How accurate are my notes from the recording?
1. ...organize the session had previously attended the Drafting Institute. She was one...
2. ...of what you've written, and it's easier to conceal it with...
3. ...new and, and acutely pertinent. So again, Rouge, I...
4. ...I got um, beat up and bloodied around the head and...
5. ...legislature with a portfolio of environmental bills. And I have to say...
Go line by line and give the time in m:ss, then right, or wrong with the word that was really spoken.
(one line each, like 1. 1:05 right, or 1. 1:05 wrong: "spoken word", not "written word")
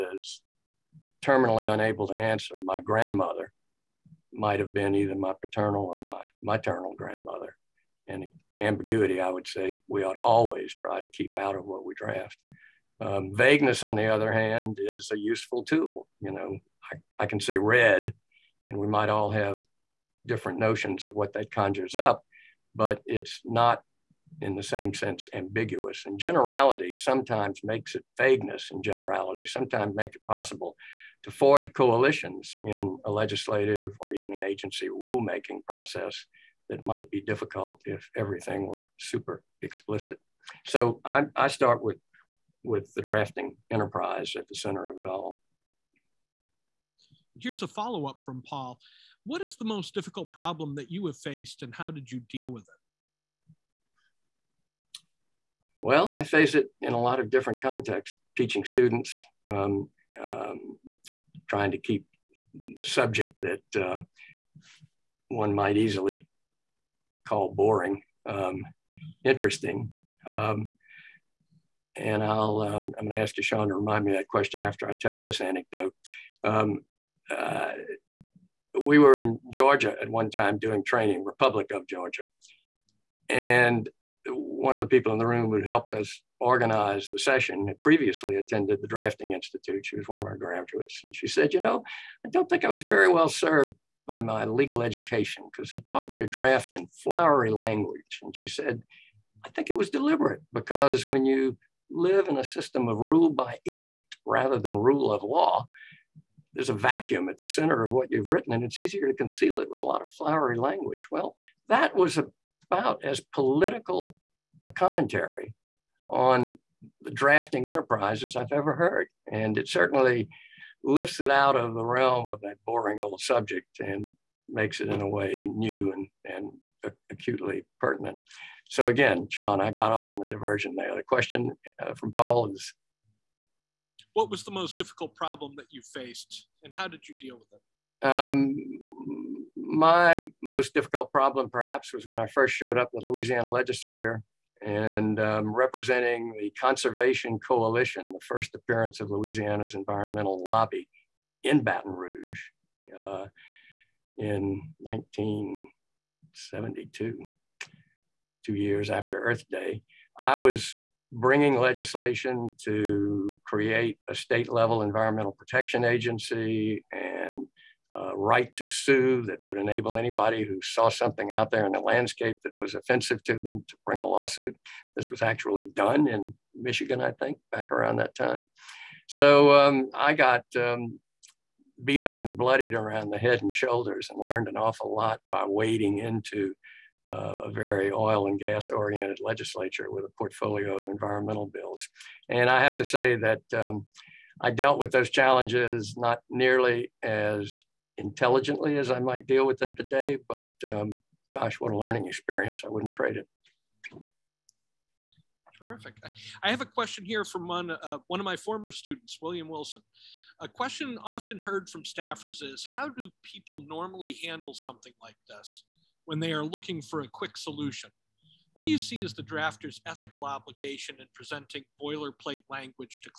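1. 1:26 right
2. 1:47 right
3. 2:05 wrong: "Sean", not "Rouge"
4. 2:59 right
5. 3:09 right.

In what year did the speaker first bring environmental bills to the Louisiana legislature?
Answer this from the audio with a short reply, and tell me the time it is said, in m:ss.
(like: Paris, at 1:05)
1972, at 2:34.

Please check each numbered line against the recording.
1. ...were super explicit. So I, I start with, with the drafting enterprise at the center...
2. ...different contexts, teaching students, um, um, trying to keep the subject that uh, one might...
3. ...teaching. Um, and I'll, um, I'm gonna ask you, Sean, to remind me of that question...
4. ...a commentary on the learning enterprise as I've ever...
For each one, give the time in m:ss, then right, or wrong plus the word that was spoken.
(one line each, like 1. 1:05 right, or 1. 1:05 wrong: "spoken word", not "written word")
1. 0:38 right
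2. 0:57 right
3. 1:09 wrong: "interesting", not "teaching"
4. 1:54 wrong: "drafting", not "learning".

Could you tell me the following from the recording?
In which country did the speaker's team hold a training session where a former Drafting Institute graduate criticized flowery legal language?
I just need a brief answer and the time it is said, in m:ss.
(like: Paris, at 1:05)
Republic of Georgia, at 1:21.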